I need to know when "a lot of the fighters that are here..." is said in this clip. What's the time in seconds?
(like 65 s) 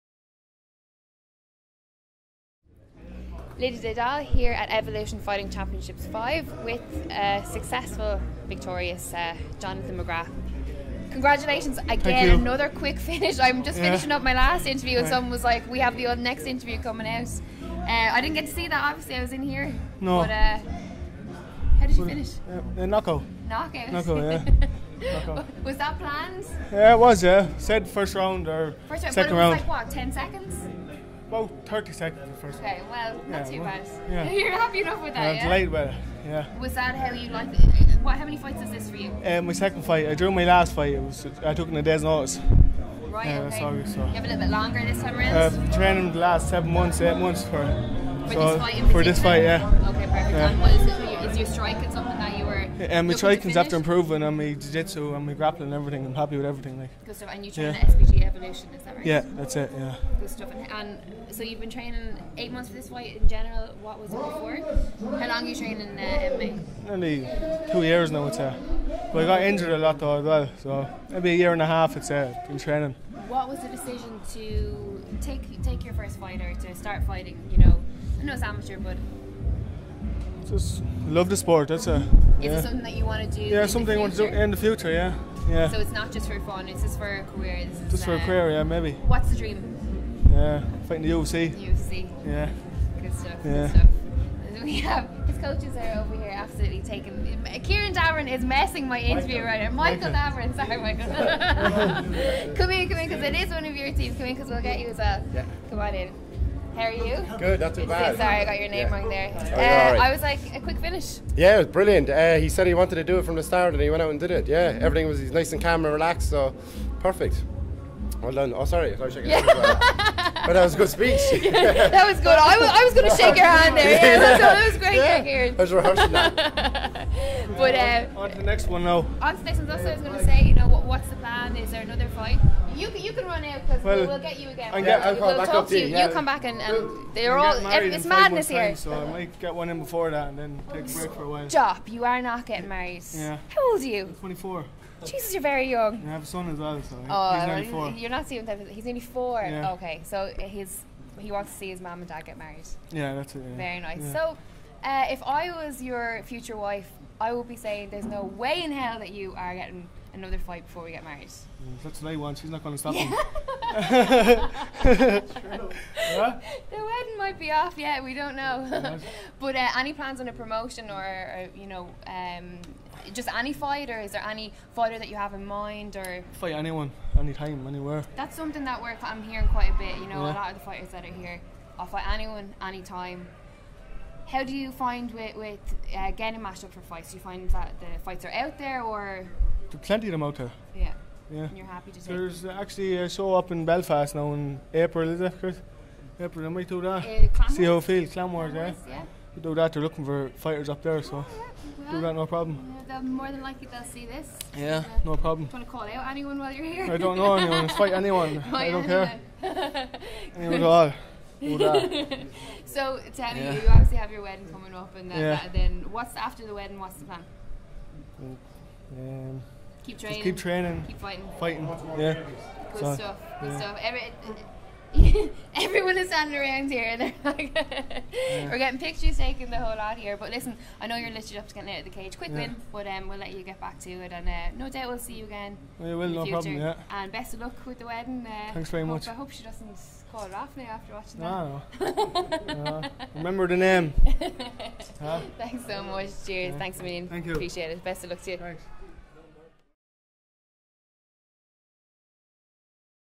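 180 s.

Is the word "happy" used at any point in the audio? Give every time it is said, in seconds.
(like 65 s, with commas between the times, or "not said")
34 s, 56 s, 191 s.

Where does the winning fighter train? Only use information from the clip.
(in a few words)
SPG Evolution.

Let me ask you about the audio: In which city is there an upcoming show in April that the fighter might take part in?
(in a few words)
Belfast.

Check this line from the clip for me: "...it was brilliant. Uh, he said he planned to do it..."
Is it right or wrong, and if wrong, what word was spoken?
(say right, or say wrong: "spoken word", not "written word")
wrong: "wanted", not "planned".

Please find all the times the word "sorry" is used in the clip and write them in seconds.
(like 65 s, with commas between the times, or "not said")
100 s, 108 s, 118 s.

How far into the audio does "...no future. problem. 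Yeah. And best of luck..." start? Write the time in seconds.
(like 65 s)
236 s.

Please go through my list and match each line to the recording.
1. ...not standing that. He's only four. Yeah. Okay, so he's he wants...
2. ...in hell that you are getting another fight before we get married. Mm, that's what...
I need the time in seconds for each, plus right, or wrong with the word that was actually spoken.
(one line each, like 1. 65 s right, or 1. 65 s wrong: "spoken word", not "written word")
1. 148 s wrong: "seeing", not "standing"
2. 158 s right.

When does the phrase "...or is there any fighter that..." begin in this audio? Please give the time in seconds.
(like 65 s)
173 s.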